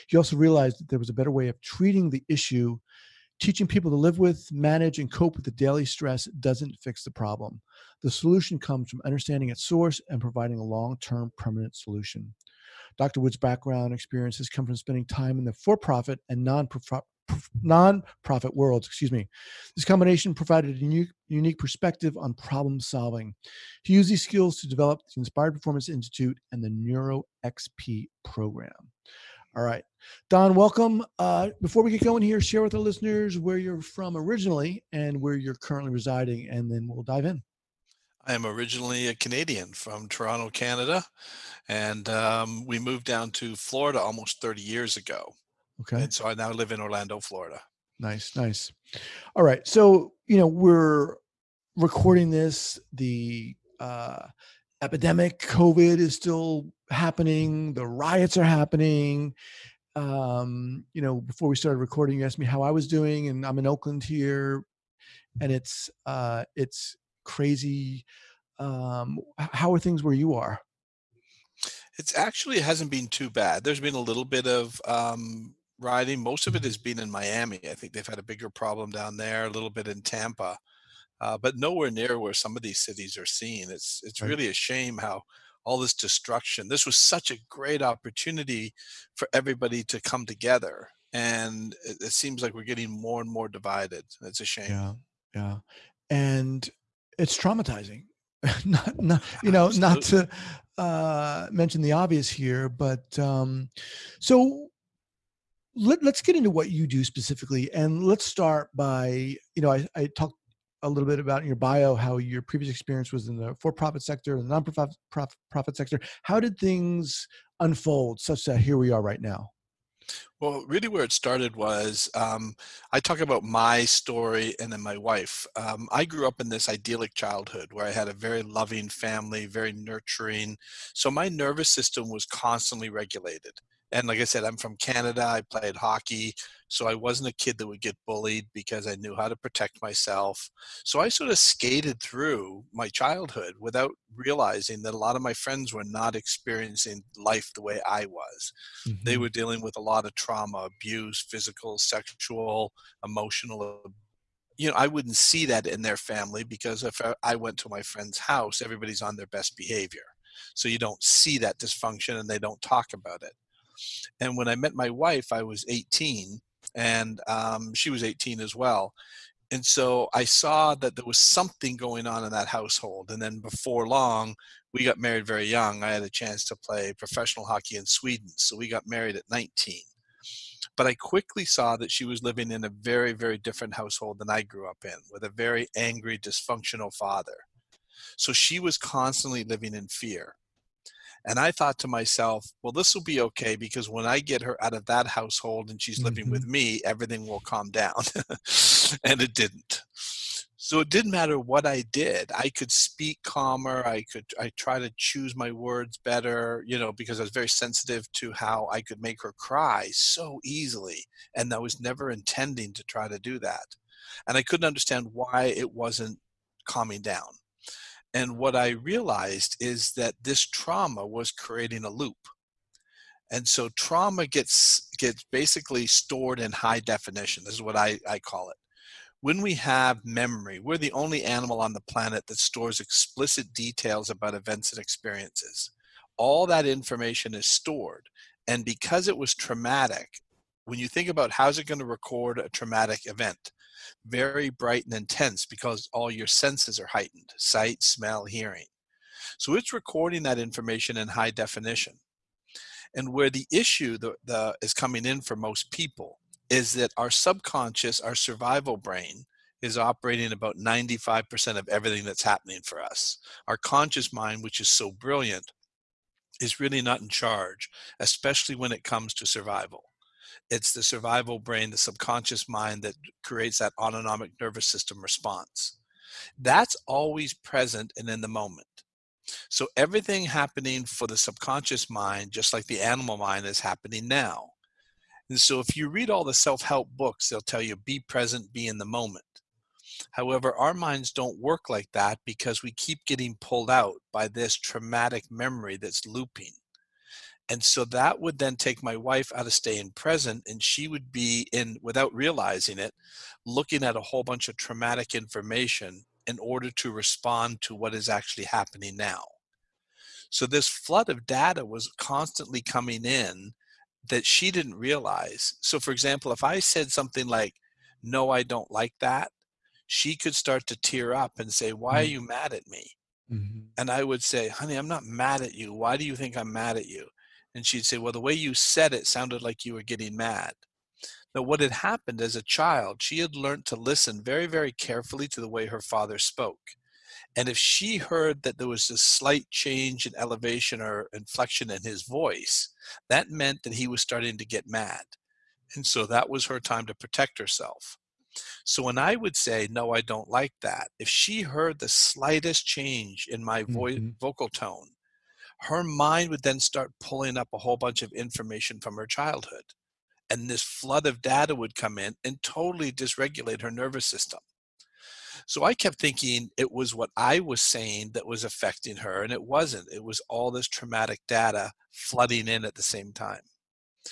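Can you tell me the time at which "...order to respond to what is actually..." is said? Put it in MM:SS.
05:06.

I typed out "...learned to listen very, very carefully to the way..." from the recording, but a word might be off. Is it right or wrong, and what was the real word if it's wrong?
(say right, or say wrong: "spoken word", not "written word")
right.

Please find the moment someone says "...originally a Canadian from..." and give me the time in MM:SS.
00:38.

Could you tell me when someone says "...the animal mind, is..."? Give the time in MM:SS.
04:42.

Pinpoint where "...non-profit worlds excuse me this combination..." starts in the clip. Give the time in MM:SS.
00:16.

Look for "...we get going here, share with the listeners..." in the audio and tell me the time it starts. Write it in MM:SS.
00:31.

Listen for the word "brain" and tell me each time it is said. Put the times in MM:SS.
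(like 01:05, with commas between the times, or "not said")
04:18, 04:31.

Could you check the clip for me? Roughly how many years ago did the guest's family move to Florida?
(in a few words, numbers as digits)
30.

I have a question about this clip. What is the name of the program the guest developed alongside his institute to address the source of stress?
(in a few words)
NeuroXP.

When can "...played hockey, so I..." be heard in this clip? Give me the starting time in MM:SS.
02:15.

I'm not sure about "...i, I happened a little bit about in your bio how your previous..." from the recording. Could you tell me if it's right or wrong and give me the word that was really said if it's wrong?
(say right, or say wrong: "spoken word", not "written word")
wrong: "talked", not "happened".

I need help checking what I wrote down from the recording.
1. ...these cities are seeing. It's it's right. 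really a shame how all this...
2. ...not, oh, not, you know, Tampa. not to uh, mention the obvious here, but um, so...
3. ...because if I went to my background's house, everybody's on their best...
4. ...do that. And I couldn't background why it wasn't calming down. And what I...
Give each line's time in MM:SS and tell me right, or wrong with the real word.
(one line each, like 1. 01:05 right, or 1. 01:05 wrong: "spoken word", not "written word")
1. 01:22 right
2. 01:38 wrong: "Absolutely", not "Tampa"
3. 02:36 wrong: "friend", not "background"
4. 03:33 wrong: "understand", not "background".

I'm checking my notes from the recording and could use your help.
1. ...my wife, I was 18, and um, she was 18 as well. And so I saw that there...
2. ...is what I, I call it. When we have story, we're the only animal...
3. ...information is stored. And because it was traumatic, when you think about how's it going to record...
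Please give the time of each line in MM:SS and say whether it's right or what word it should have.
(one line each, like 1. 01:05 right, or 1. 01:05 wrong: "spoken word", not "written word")
1. 02:44 right
2. 03:47 wrong: "memory", not "story"
3. 03:56 right.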